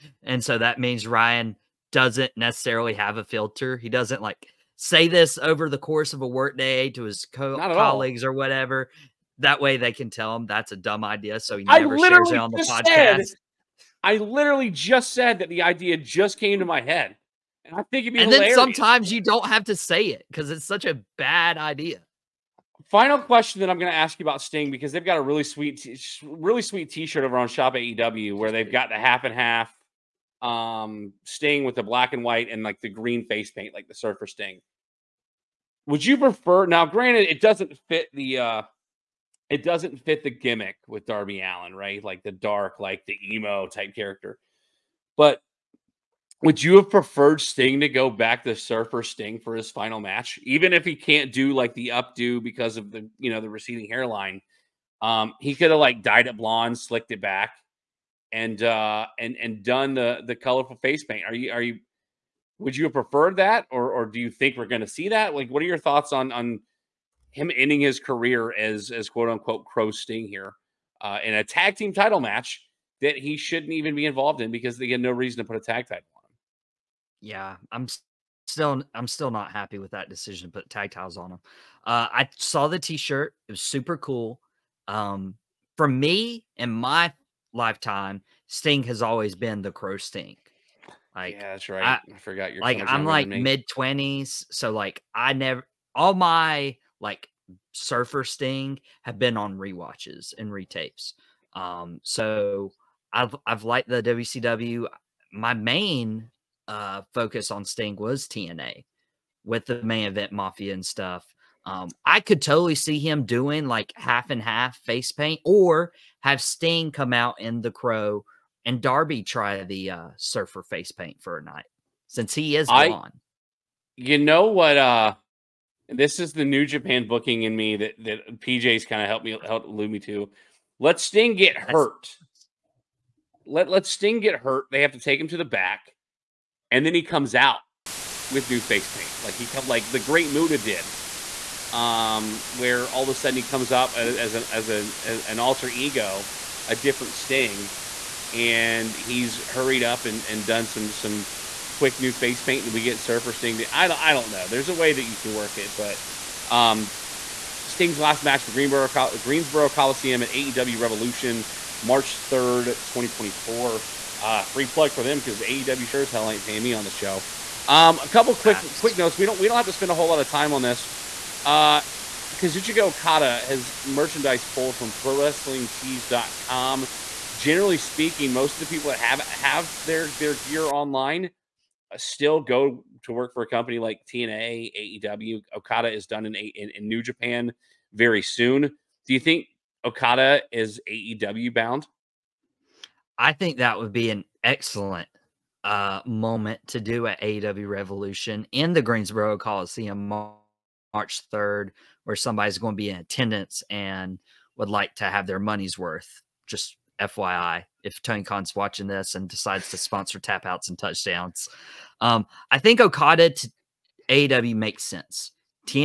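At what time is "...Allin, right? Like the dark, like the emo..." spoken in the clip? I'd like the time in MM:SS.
00:41.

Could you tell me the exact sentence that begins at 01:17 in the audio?
Yeah, I'm still I'm still not happy with that decision.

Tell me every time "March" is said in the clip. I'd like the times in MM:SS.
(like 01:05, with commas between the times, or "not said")
02:41, 03:20.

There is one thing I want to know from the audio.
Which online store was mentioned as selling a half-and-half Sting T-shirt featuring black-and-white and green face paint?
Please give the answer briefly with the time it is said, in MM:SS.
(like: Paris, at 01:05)
Shop AEW, at 00:27.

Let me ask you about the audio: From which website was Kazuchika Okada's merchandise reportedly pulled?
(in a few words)
ProWrestlingTees.com.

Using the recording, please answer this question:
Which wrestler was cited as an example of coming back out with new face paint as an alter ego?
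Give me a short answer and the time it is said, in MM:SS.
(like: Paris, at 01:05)
The Great Muta, at 02:19.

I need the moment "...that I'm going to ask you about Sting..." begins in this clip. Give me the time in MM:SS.
00:23.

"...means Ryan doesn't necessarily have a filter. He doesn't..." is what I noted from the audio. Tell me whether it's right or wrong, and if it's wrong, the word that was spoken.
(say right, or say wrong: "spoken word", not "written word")
right.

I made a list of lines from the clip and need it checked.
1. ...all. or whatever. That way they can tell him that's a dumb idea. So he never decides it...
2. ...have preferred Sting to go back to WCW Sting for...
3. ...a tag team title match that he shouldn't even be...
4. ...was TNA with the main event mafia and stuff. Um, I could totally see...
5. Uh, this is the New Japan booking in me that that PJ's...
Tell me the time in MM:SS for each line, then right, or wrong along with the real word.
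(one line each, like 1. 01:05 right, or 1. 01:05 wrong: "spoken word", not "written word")
1. 00:08 wrong: "shares", not "decides"
2. 00:46 wrong: "Surfer", not "WCW"
3. 01:11 right
4. 01:47 right
5. 02:04 right.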